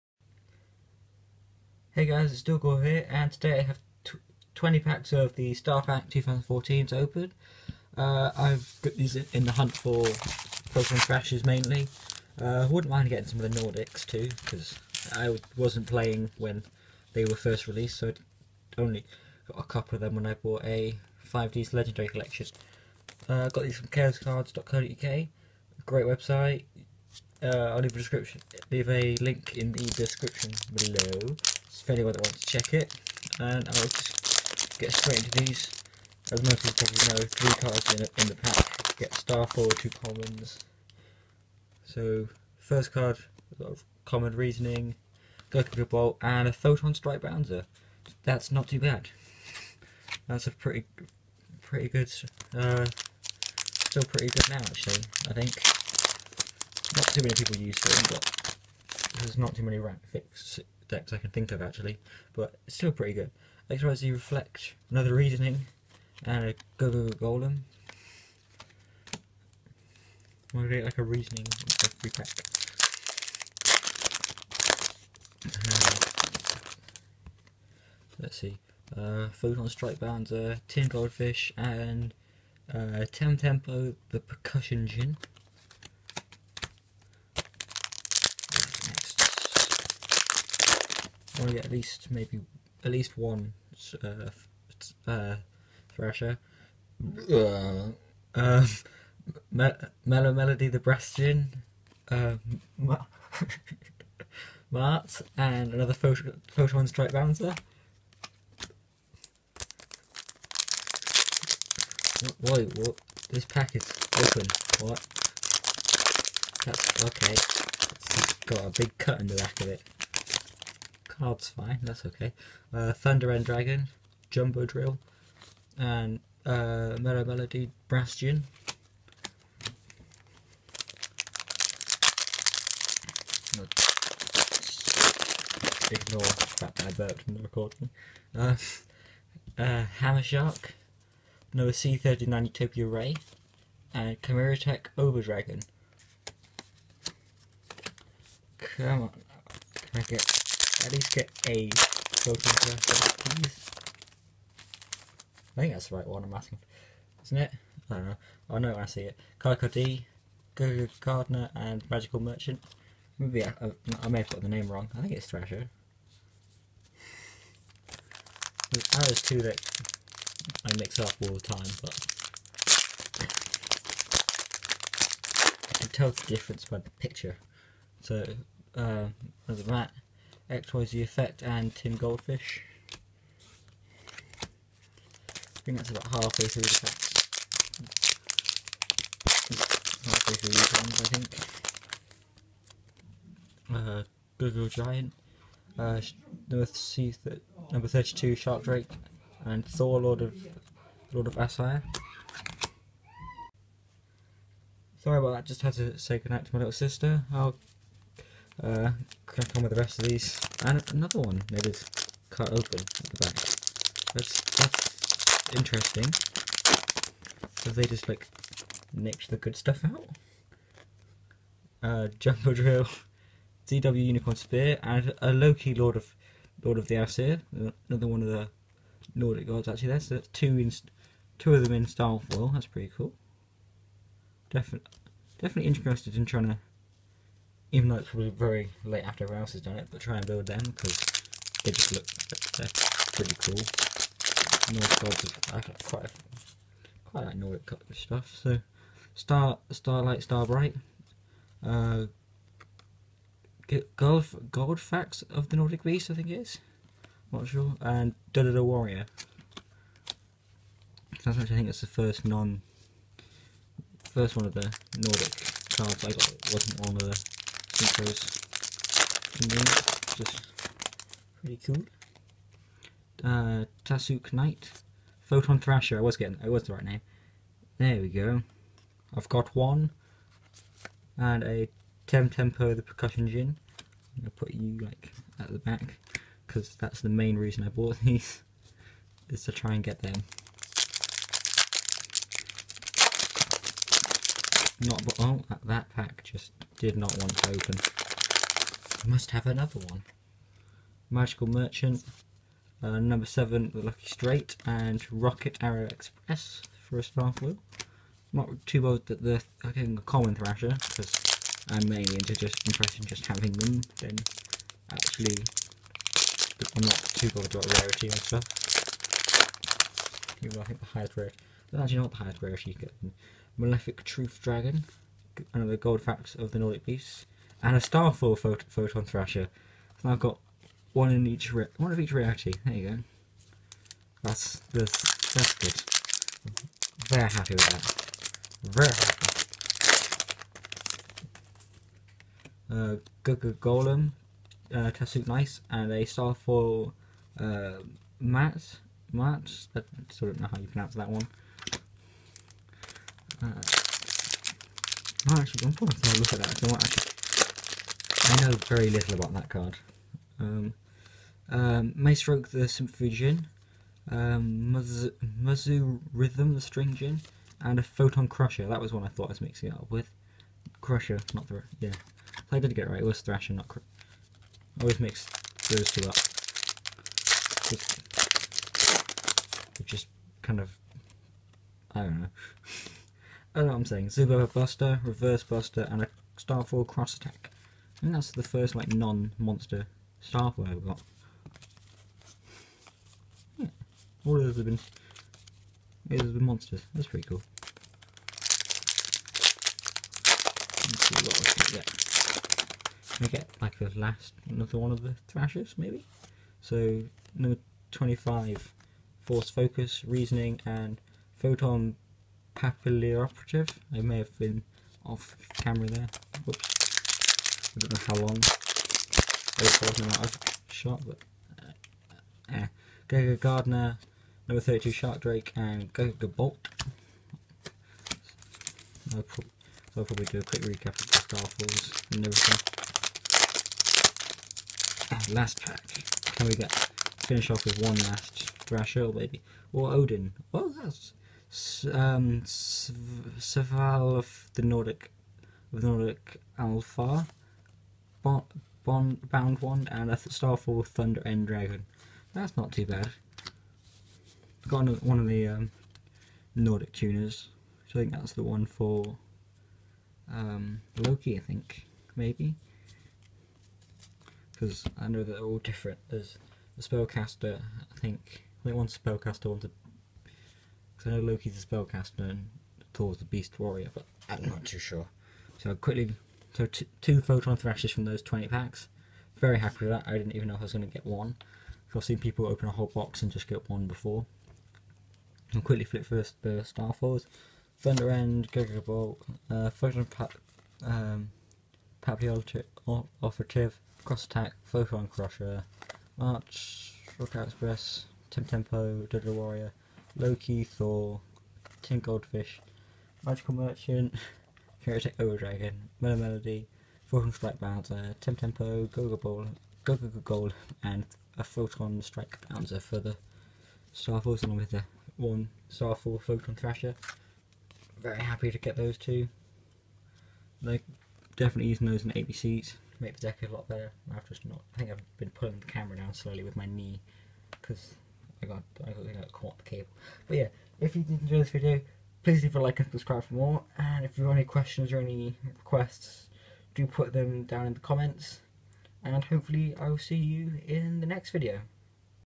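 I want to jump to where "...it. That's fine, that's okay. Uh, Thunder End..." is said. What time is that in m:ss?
1:59.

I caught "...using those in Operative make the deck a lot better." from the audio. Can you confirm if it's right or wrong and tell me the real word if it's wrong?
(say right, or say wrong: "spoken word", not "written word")
wrong: "ABCs", not "Operative".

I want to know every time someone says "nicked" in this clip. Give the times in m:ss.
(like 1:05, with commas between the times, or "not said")
3:38.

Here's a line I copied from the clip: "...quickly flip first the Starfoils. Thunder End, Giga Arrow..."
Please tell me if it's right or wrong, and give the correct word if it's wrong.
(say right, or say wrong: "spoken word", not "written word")
wrong: "Bolt", not "Arrow".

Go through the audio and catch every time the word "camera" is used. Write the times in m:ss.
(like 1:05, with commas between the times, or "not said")
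6:55, 8:45.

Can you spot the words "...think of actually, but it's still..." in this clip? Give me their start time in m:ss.
1:01.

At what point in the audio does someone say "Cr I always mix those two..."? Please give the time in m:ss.
6:13.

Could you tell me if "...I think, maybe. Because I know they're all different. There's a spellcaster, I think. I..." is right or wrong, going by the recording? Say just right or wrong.
right.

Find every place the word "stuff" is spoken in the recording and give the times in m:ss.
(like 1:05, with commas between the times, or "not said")
3:39, 4:07, 5:18.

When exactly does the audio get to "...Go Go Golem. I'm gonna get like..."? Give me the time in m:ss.
1:06.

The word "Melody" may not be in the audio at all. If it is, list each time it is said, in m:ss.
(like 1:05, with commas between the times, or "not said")
1:40, 2:07, 8:26.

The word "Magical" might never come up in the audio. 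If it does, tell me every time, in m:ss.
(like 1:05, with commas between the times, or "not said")
2:41, 5:01, 8:23.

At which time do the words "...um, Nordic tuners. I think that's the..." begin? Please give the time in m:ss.
7:35.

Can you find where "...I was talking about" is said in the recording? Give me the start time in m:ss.
6:59.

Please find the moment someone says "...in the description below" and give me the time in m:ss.
0:29.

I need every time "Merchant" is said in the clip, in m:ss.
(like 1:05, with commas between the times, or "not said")
2:42, 5:01, 8:23.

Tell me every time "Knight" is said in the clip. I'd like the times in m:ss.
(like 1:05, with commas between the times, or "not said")
4:34, 5:45.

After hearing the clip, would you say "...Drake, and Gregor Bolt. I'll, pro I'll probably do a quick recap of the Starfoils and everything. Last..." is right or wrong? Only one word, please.
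right.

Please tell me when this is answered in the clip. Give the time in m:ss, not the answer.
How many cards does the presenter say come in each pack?
0:37.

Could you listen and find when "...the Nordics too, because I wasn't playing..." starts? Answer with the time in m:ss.
0:13.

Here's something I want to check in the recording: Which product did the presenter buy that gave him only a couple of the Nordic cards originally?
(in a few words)
5D's Legendary Collection.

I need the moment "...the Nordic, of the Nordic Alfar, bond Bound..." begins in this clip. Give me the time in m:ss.
7:24.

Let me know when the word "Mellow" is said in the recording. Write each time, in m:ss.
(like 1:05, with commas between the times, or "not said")
1:39, 2:06, 8:26.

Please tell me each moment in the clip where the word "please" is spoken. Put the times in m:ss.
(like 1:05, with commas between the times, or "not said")
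2:31, 8:52.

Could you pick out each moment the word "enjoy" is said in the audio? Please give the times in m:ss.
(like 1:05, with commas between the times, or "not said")
8:51.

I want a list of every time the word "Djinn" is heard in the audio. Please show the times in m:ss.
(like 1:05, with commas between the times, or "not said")
1:41, 4:43, 6:06.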